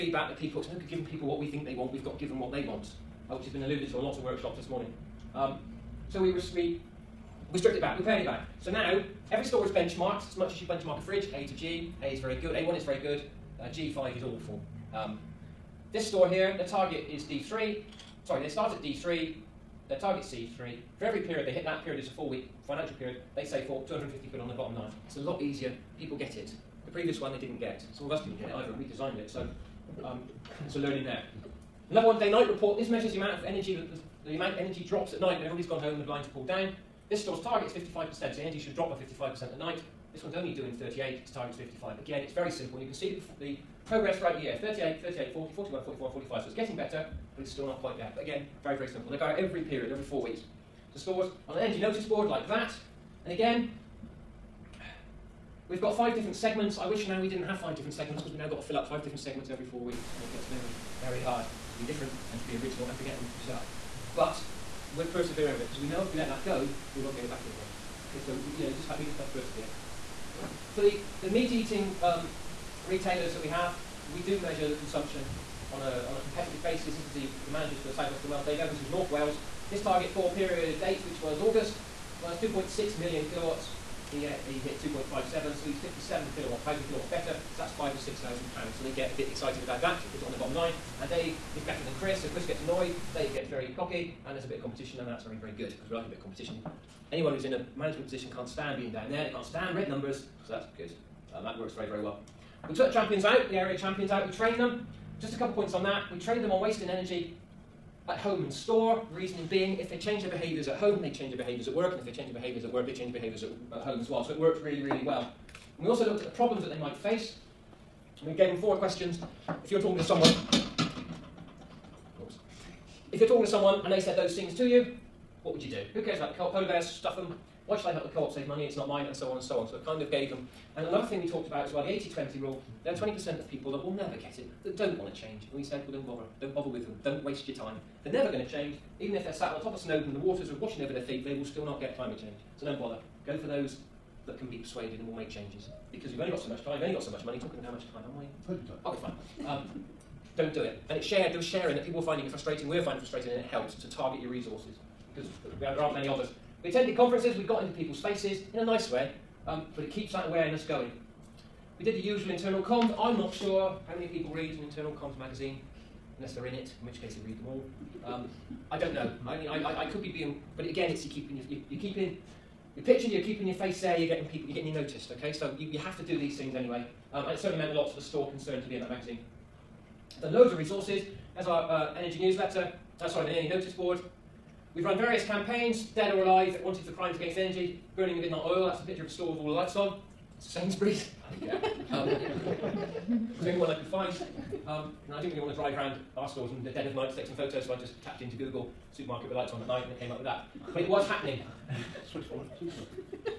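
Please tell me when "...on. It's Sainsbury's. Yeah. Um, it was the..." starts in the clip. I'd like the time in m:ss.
3:09.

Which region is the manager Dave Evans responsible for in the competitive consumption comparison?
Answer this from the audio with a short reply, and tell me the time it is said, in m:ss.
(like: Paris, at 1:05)
North Wales, at 1:18.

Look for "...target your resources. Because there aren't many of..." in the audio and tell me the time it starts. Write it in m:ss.
2:33.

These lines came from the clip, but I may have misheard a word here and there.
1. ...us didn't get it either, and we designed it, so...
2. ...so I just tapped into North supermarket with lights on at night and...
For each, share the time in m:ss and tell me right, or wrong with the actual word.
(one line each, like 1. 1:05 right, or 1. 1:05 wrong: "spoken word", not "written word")
1. 0:28 right
2. 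3:17 wrong: "Google", not "North".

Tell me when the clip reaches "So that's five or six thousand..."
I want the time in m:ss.
1:27.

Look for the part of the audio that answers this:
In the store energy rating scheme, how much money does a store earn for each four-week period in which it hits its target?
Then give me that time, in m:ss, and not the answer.
0:23.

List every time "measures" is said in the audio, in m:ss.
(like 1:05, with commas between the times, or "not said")
0:32, 1:14.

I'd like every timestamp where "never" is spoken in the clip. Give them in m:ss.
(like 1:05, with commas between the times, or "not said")
2:13, 2:18.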